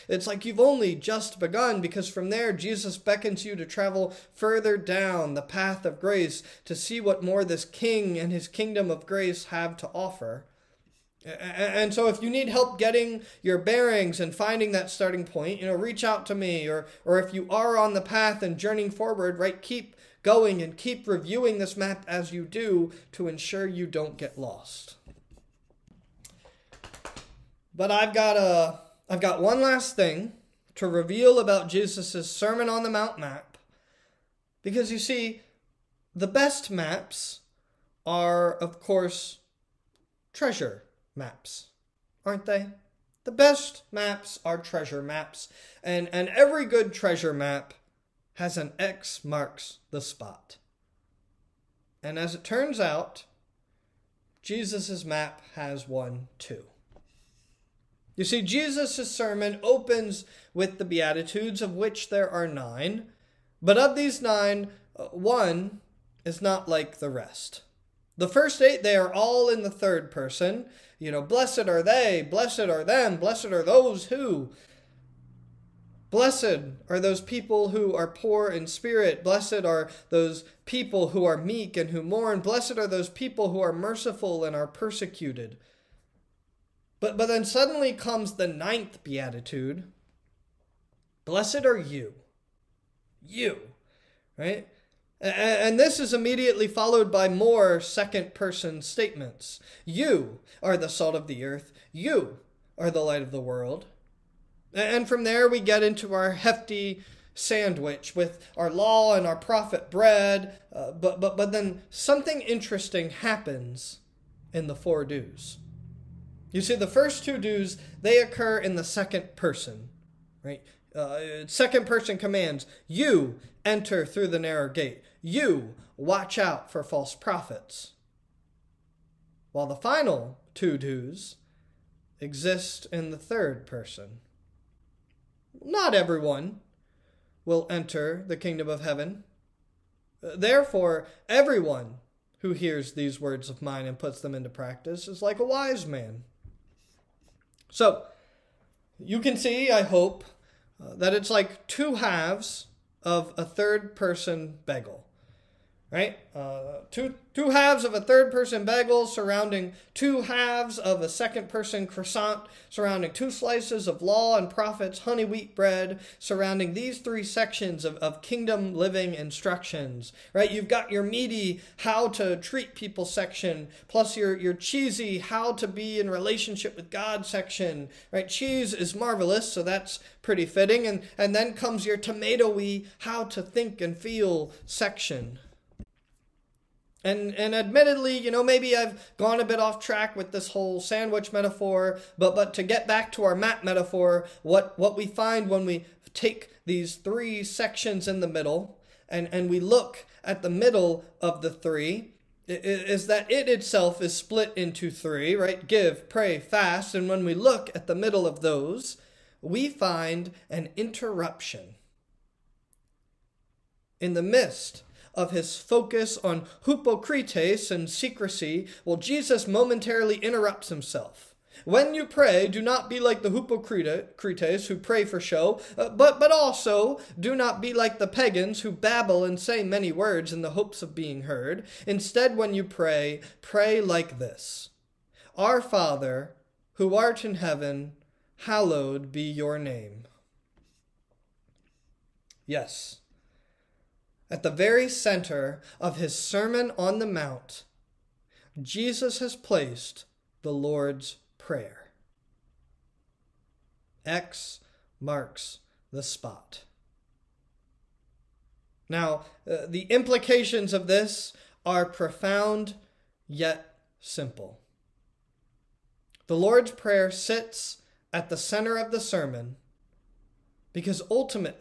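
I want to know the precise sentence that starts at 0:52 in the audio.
And as it turns out, Jesus' map has one too.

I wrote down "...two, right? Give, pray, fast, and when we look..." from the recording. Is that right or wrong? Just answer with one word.
wrong.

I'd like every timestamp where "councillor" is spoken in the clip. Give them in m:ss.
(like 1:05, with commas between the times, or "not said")
not said.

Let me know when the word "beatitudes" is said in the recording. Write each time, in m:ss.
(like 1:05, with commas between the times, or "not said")
1:00, 1:29.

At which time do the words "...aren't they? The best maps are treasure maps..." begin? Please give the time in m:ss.
0:42.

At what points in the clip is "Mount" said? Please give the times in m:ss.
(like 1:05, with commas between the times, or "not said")
0:32, 4:07.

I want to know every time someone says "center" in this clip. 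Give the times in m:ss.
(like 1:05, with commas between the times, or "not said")
4:04, 4:28.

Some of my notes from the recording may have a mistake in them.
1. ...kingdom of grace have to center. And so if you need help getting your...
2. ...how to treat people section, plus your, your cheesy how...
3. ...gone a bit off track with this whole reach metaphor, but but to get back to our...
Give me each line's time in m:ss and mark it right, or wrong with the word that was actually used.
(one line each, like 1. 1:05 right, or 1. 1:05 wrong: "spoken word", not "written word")
1. 0:08 wrong: "offer", not "center"
2. 2:51 right
3. 3:09 wrong: "sandwich", not "reach".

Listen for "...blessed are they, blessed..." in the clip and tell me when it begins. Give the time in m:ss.
1:11.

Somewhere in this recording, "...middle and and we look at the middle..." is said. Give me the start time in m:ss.
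3:18.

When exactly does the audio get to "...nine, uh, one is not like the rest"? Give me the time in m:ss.
1:04.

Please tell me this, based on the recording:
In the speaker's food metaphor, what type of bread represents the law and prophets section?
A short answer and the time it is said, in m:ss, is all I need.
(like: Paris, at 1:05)
Honey wheat bread, at 2:45.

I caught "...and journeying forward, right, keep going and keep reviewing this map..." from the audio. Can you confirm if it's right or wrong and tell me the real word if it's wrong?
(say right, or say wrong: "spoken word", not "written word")
right.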